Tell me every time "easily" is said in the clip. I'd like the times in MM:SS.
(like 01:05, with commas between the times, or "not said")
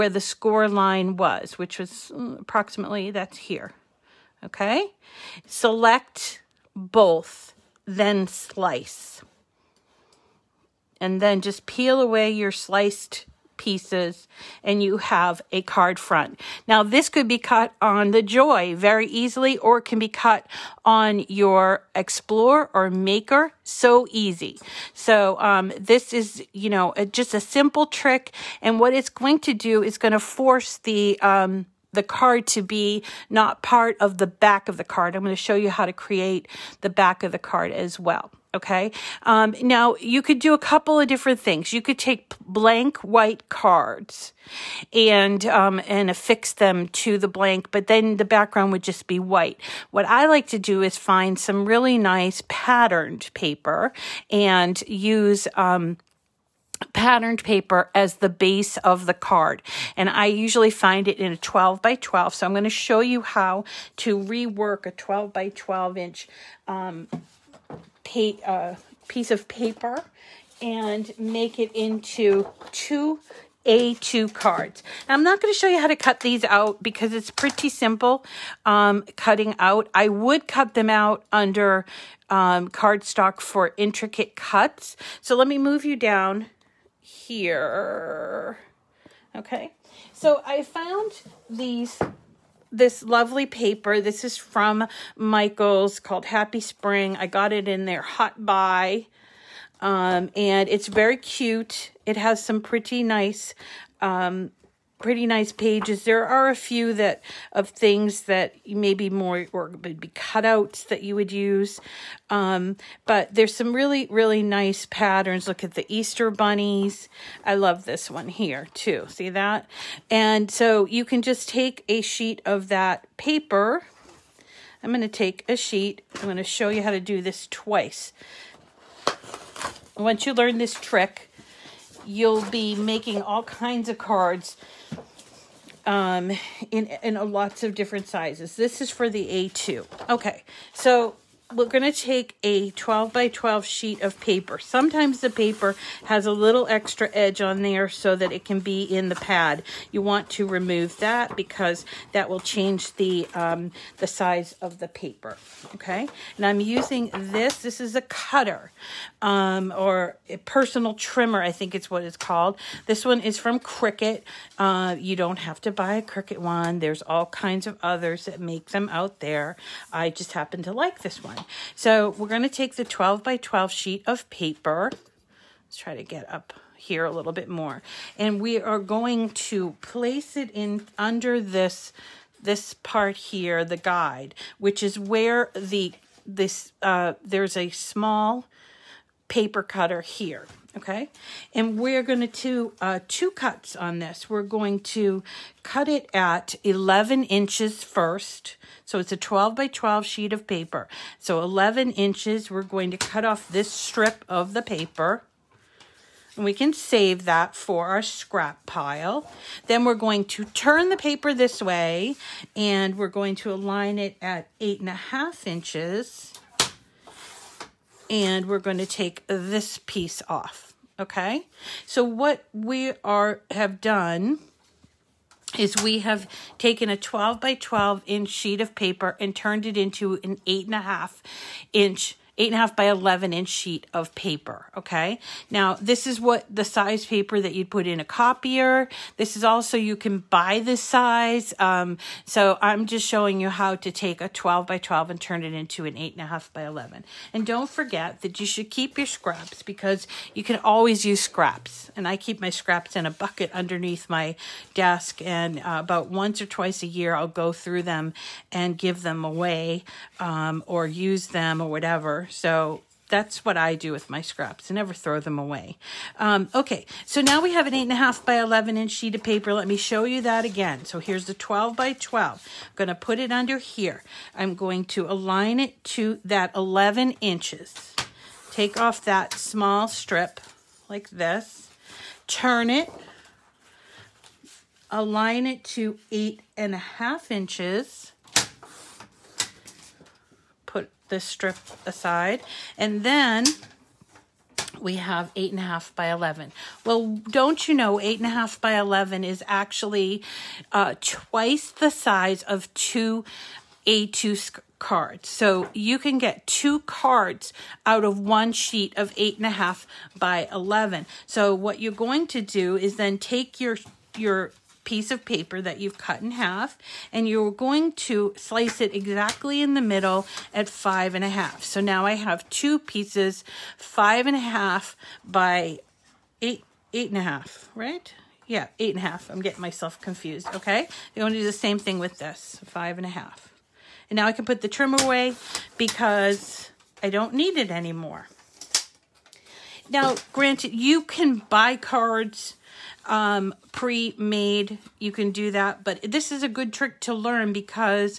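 00:19.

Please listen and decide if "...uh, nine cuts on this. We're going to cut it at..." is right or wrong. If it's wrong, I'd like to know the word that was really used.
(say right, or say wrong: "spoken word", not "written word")
wrong: "two", not "nine".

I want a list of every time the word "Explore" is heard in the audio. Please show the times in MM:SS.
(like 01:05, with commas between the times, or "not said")
00:21.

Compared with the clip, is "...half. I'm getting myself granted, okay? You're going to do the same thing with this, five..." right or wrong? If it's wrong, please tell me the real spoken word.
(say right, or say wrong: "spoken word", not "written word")
wrong: "confused", not "granted".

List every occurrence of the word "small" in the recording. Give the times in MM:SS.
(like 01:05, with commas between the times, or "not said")
03:07, 04:39.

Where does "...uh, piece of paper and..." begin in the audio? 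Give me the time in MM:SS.
01:08.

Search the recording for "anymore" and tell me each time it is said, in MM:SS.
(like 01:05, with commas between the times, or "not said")
05:37.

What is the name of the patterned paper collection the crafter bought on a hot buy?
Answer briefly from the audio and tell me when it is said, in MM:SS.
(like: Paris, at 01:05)
Happy Spring, at 01:36.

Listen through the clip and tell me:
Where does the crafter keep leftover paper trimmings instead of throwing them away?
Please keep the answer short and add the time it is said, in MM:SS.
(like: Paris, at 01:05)
In a bucket, at 04:12.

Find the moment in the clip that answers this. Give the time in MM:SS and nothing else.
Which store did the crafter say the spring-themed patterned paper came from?
01:35.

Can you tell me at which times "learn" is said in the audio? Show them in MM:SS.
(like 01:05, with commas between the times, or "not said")
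02:10, 05:47.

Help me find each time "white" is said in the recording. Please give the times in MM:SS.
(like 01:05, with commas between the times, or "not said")
00:42, 00:49.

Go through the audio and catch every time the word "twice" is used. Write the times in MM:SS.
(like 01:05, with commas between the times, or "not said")
02:07, 04:16, 05:00.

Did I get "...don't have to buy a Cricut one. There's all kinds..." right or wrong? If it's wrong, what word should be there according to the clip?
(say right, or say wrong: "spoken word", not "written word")
right.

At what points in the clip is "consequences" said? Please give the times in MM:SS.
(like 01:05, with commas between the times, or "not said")
not said.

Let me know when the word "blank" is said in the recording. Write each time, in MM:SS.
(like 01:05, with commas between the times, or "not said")
00:42, 00:47.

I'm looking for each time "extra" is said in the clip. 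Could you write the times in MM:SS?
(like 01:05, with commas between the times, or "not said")
02:26.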